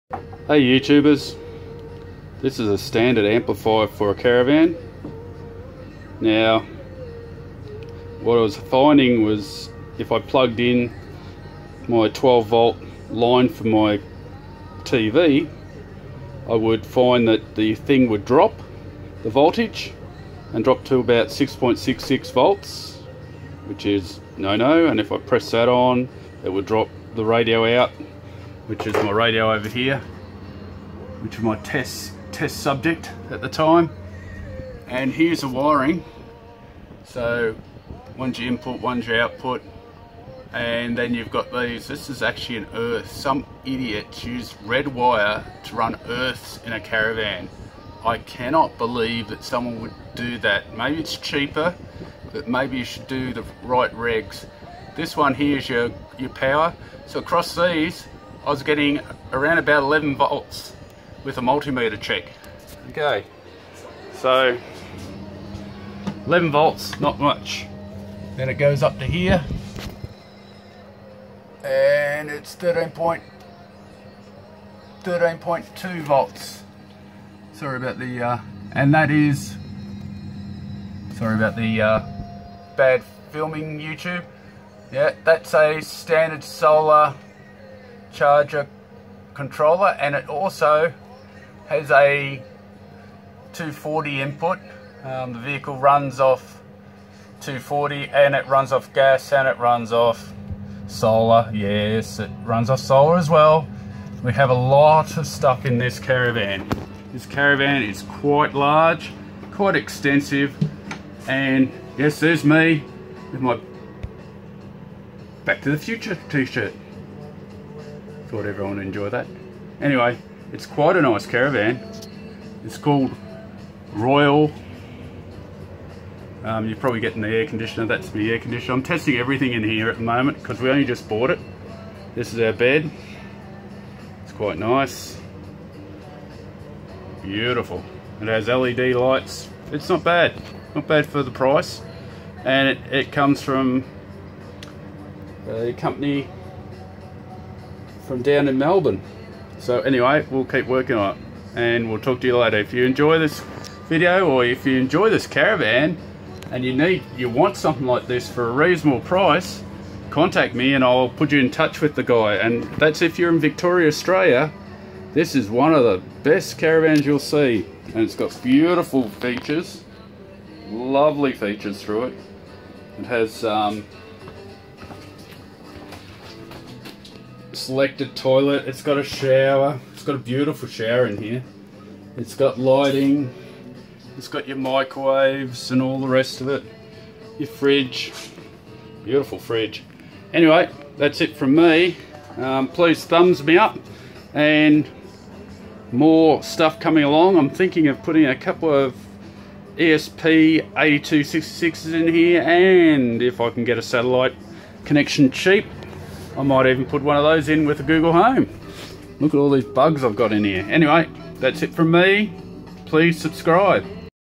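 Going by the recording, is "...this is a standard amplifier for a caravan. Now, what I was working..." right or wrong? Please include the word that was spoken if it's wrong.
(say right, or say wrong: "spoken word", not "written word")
wrong: "finding", not "working".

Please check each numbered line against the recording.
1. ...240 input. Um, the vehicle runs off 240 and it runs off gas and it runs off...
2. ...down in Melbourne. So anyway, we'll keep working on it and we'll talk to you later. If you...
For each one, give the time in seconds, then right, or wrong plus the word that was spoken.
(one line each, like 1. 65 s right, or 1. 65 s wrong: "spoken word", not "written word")
1. 93 s right
2. 148 s right.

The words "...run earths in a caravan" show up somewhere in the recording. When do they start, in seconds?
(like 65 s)
45 s.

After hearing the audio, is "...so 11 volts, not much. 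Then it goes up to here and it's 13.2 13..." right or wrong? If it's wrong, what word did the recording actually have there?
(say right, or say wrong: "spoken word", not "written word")
right.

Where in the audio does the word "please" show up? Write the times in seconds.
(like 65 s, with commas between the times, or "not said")
192 s, 212 s.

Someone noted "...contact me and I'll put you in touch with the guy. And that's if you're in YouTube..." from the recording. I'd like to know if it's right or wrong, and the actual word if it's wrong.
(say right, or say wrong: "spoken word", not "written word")
wrong: "Victoria", not "YouTube".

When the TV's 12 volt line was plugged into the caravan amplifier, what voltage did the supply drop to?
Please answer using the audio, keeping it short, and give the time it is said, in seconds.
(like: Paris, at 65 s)
6.66 volts, at 21 s.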